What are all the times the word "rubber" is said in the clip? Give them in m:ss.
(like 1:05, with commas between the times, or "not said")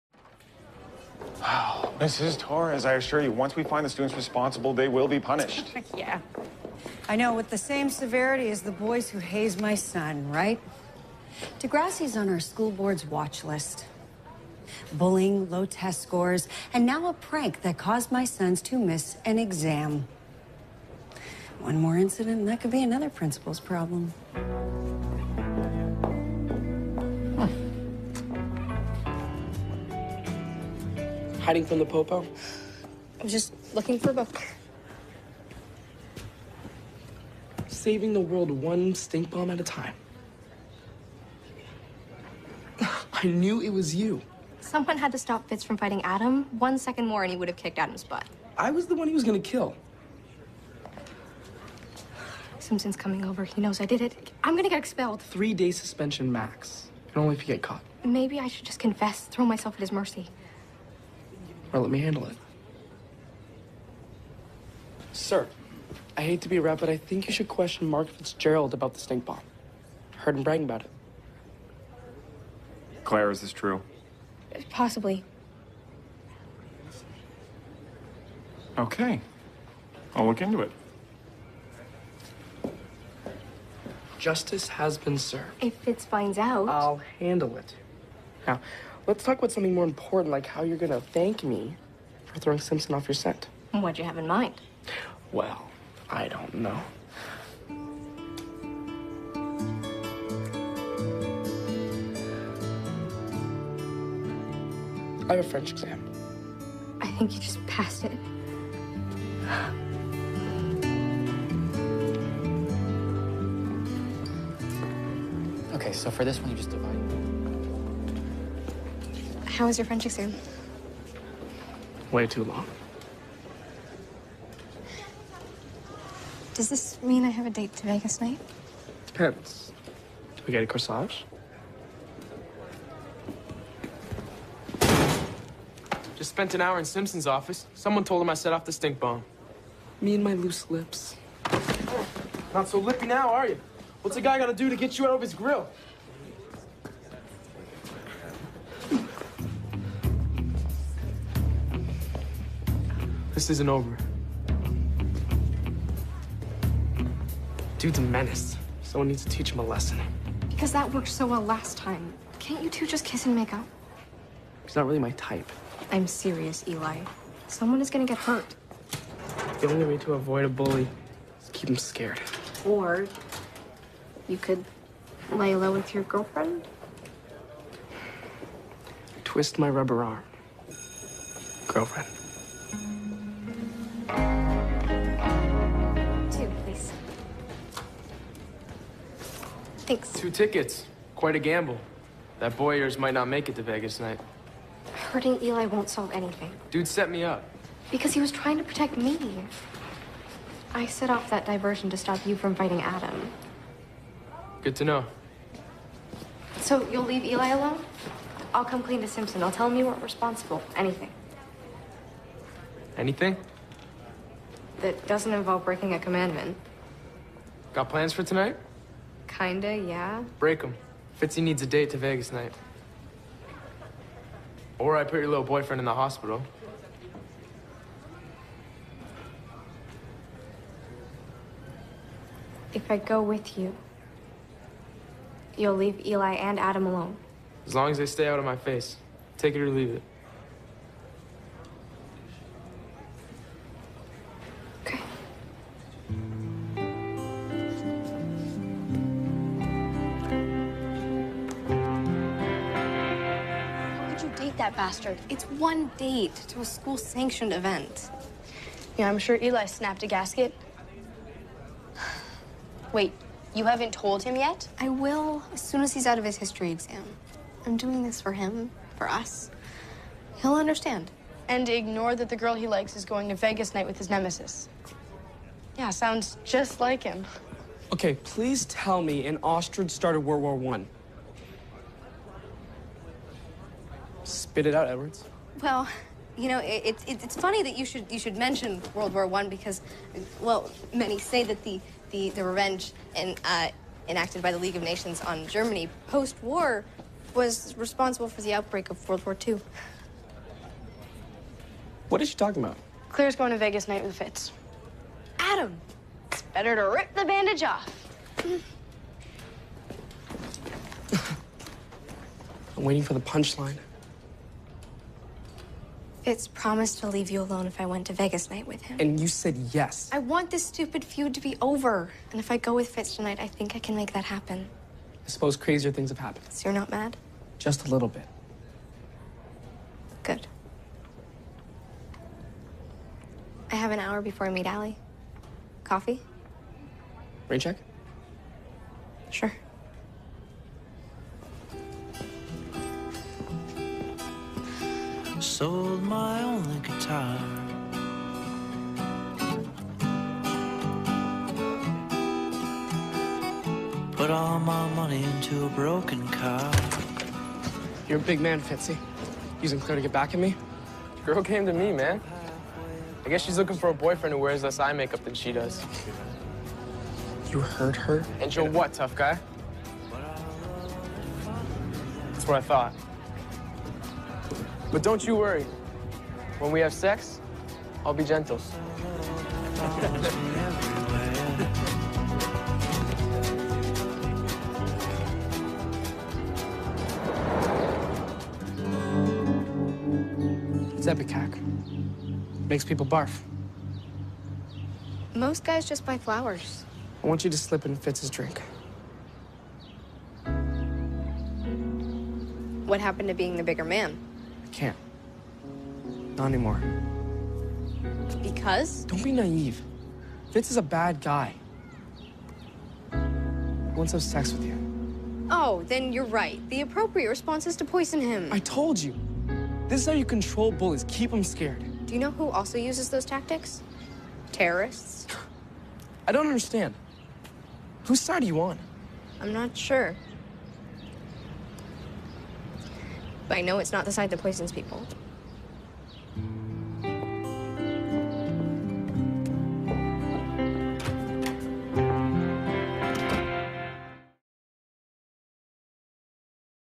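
2:59.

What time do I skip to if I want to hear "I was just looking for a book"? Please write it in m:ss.
0:33.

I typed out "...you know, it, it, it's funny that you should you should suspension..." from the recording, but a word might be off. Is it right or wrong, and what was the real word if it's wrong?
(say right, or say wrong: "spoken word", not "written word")
wrong: "mention", not "suspension".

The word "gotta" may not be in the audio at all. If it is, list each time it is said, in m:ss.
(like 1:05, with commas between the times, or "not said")
2:24.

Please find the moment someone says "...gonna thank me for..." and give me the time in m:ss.
1:30.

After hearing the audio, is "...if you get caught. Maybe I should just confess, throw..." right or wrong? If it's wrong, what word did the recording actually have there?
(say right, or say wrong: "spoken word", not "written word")
right.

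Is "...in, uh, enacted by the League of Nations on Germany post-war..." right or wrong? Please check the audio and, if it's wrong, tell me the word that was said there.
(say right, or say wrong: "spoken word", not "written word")
right.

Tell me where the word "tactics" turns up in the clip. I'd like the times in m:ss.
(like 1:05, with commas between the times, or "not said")
7:03.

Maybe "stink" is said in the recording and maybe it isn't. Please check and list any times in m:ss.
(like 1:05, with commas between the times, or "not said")
0:38, 1:08, 2:18.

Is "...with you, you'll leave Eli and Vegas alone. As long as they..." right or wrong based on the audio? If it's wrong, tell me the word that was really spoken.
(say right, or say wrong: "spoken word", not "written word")
wrong: "Adam", not "Vegas".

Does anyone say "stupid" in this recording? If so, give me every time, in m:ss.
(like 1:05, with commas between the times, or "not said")
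5:20.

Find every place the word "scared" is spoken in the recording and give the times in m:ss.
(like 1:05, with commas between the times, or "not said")
2:51, 7:01.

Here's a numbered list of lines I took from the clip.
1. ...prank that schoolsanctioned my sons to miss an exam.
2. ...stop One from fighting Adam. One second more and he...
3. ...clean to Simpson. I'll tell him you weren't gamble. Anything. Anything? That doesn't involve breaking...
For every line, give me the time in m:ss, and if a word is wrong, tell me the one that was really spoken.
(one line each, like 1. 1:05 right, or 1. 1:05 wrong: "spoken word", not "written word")
1. 0:17 wrong: "caused", not "schoolsanctioned"
2. 0:45 wrong: "Fitz", not "One"
3. 3:28 wrong: "responsible", not "gamble".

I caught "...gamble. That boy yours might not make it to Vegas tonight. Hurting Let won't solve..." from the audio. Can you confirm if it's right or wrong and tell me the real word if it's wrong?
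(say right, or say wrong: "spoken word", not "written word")
wrong: "Eli", not "Let".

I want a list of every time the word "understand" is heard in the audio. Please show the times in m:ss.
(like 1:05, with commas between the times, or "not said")
4:30, 7:06.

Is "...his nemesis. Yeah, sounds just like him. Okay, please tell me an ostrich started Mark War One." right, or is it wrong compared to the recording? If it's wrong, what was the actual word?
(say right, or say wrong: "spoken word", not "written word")
wrong: "World", not "Mark".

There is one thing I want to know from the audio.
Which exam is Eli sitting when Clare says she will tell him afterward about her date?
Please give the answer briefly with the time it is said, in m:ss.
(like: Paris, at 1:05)
History exam, at 4:26.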